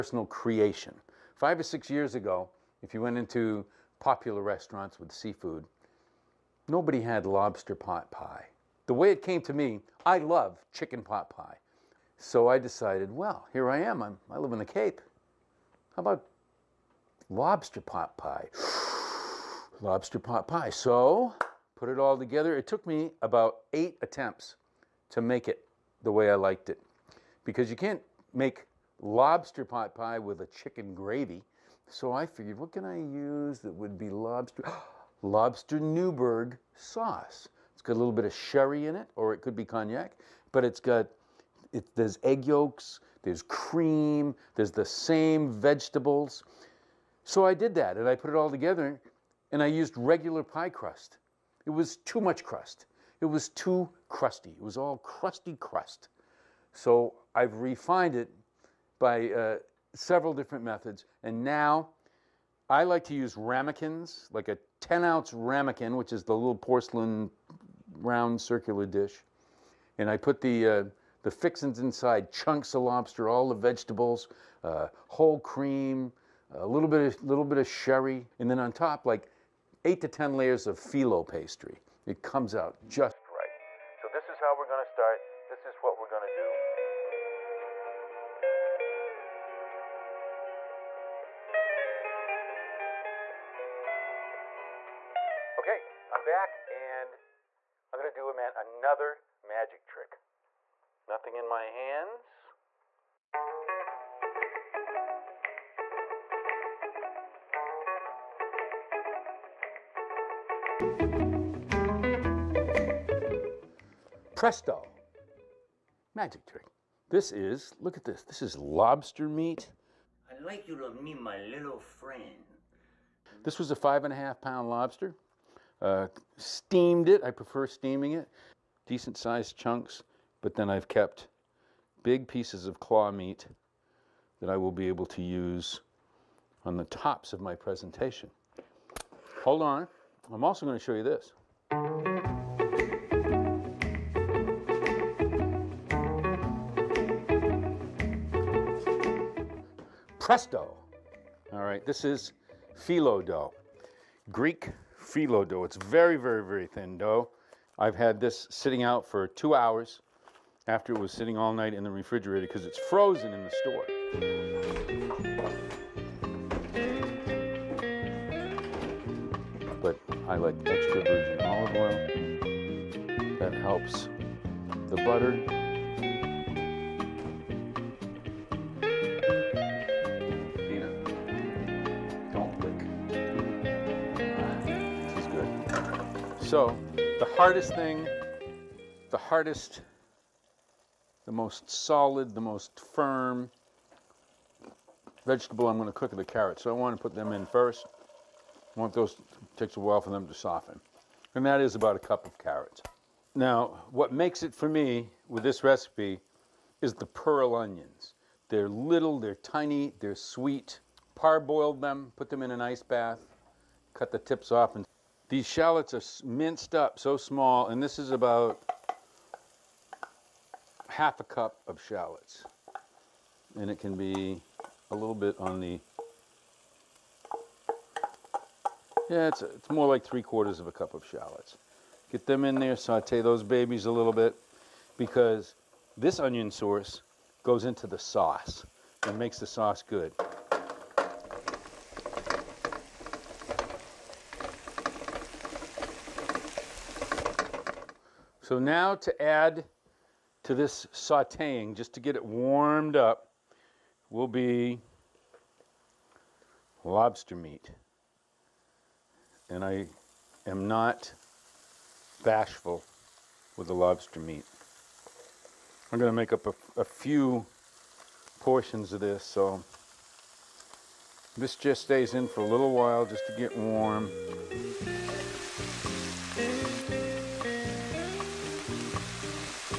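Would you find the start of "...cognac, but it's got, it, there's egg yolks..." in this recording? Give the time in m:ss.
0:39.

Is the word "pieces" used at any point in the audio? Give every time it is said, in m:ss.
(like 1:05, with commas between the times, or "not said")
2:12.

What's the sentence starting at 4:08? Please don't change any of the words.
So now to add to this sauteing, just to get it warmed up, will be lobster meat.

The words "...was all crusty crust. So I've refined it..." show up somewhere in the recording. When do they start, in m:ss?
0:54.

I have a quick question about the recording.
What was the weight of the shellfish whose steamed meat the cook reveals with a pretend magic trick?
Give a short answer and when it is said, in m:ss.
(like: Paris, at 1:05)
5.5 pounds, at 2:03.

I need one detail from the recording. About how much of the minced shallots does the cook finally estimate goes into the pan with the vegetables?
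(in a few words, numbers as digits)
3/4 cup.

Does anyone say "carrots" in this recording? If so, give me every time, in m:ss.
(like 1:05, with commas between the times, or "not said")
3:16, 3:22.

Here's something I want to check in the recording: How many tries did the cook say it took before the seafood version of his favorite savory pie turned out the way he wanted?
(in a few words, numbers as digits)
8.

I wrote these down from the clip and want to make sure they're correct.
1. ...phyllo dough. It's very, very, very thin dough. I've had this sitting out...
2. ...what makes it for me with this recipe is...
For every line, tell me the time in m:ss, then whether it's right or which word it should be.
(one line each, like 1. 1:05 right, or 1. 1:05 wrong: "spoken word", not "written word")
1. 2:35 right
2. 3:23 right.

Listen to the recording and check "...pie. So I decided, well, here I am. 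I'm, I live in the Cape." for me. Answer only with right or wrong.
right.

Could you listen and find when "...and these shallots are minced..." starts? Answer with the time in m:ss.
3:34.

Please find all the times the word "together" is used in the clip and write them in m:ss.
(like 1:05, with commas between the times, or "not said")
0:22, 0:48.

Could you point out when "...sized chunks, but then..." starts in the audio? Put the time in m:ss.
2:09.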